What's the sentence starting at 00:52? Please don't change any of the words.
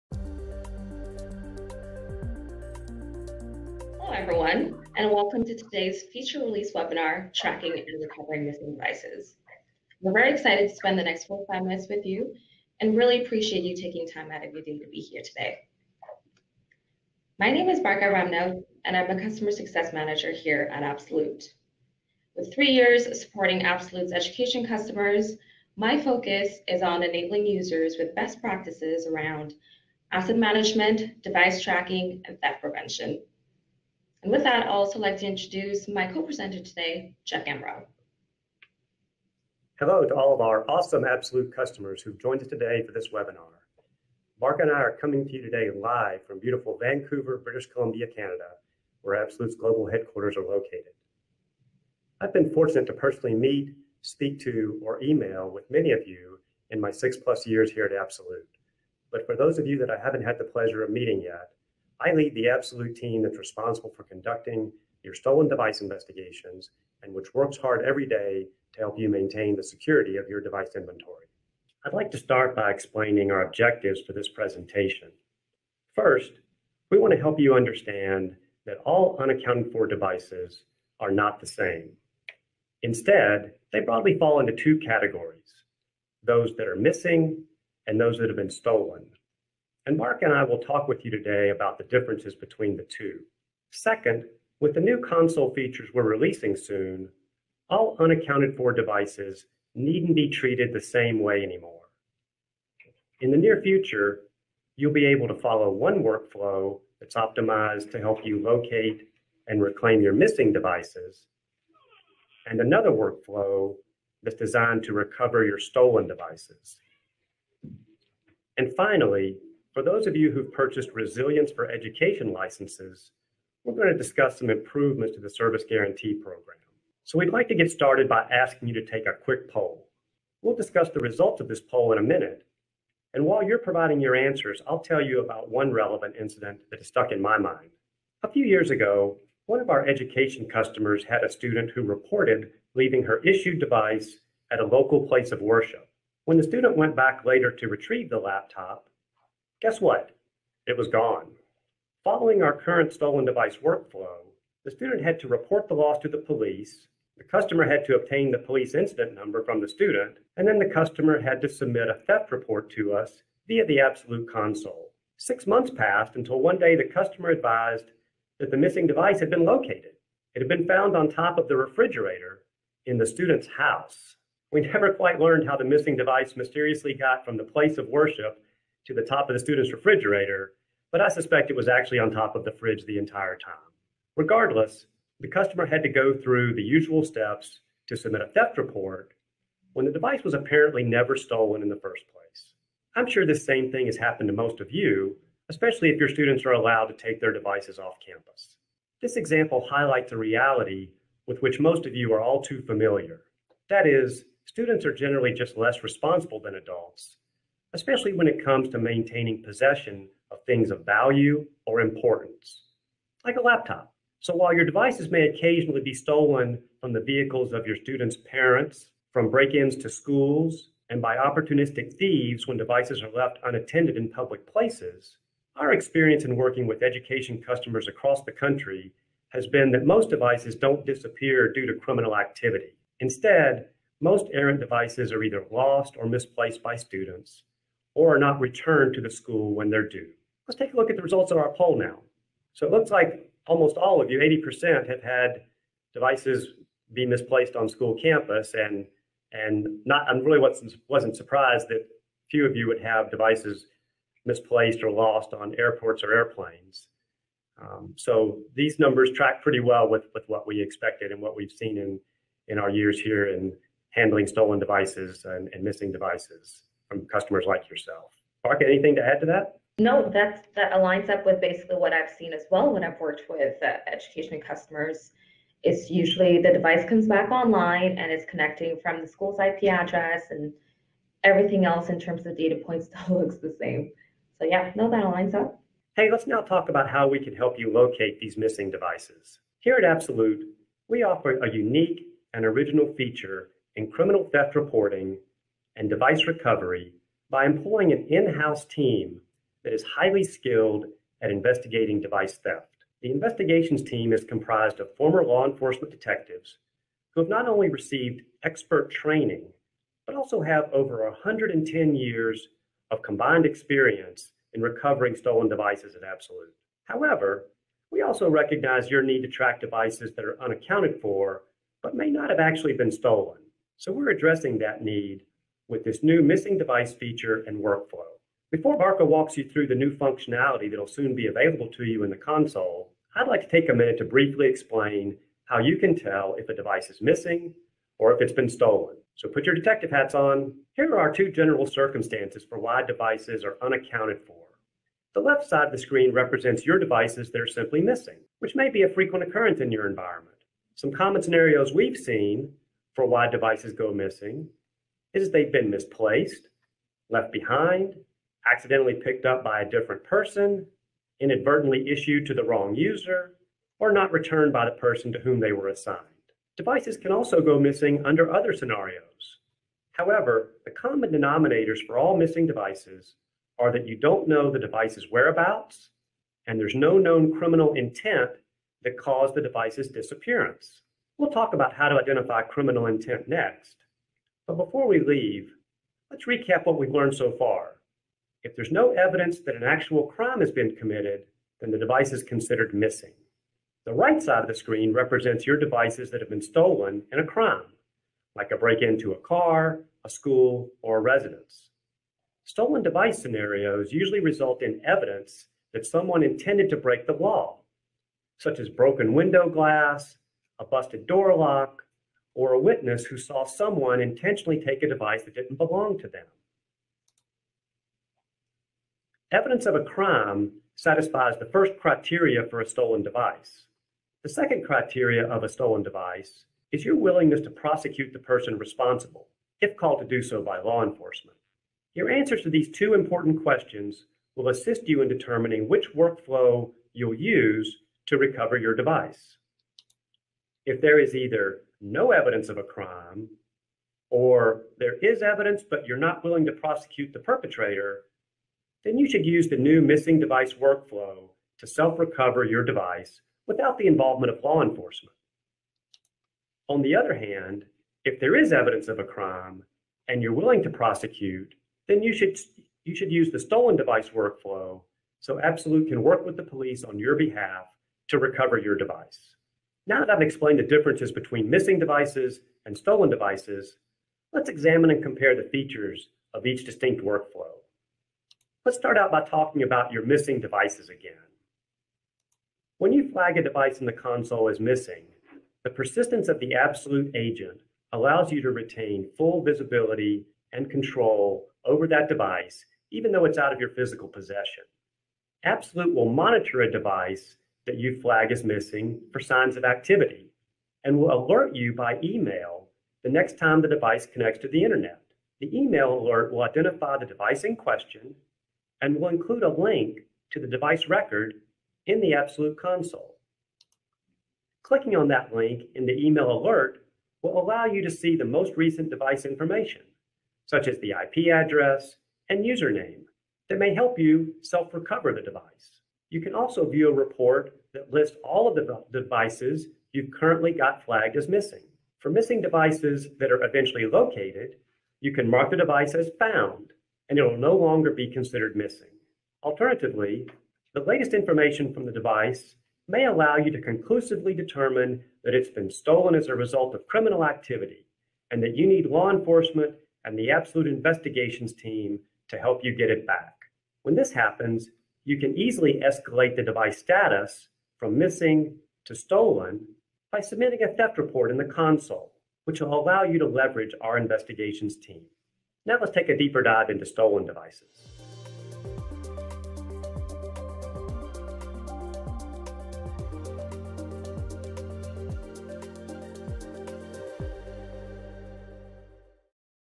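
I've been fortunate to personally meet, speak to, or email with many of you in my six plus years here at Absolute.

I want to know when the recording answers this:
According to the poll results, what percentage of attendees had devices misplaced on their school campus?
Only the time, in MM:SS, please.
04:04.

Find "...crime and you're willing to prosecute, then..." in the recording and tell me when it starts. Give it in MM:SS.
07:39.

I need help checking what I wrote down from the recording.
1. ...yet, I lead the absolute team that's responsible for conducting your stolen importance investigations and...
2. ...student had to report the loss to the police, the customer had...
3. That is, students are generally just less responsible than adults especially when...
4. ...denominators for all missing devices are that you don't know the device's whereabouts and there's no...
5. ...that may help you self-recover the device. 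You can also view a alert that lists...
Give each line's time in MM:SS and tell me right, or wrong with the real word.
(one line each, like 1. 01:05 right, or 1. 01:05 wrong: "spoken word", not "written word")
1. 01:01 wrong: "device", not "importance"
2. 02:34 right
3. 03:23 right
4. 06:11 right
5. 08:43 wrong: "report", not "alert".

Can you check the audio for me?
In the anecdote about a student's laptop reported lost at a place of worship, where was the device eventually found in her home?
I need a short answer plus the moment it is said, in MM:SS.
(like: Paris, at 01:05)
On top of the refrigerator, at 02:51.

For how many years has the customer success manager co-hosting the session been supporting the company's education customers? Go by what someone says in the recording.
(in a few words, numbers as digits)
3 years.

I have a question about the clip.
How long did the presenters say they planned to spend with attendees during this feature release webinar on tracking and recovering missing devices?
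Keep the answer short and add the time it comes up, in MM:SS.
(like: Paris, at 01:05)
45 minutes, at 00:11.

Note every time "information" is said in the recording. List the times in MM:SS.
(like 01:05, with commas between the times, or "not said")
08:39, 09:01.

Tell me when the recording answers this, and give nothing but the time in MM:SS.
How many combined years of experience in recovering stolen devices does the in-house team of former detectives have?
05:11.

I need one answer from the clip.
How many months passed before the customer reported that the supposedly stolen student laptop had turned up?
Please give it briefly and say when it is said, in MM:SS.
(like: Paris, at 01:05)
6, at 02:45.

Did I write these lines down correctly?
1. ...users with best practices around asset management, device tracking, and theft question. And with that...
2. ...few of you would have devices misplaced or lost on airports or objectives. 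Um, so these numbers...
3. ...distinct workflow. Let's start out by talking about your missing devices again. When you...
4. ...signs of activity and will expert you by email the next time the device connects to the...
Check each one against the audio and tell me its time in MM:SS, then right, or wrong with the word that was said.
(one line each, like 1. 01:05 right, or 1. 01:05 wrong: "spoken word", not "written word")
1. 00:27 wrong: "prevention", not "question"
2. 04:12 wrong: "airplanes", not "objectives"
3. 07:56 right
4. 08:19 wrong: "alert", not "expert".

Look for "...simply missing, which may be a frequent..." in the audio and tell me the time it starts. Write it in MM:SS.
05:47.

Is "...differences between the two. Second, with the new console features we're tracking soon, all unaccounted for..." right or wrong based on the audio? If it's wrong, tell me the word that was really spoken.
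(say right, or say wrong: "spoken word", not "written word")
wrong: "releasing", not "tracking".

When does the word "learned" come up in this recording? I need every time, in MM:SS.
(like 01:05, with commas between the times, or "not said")
02:55, 06:26.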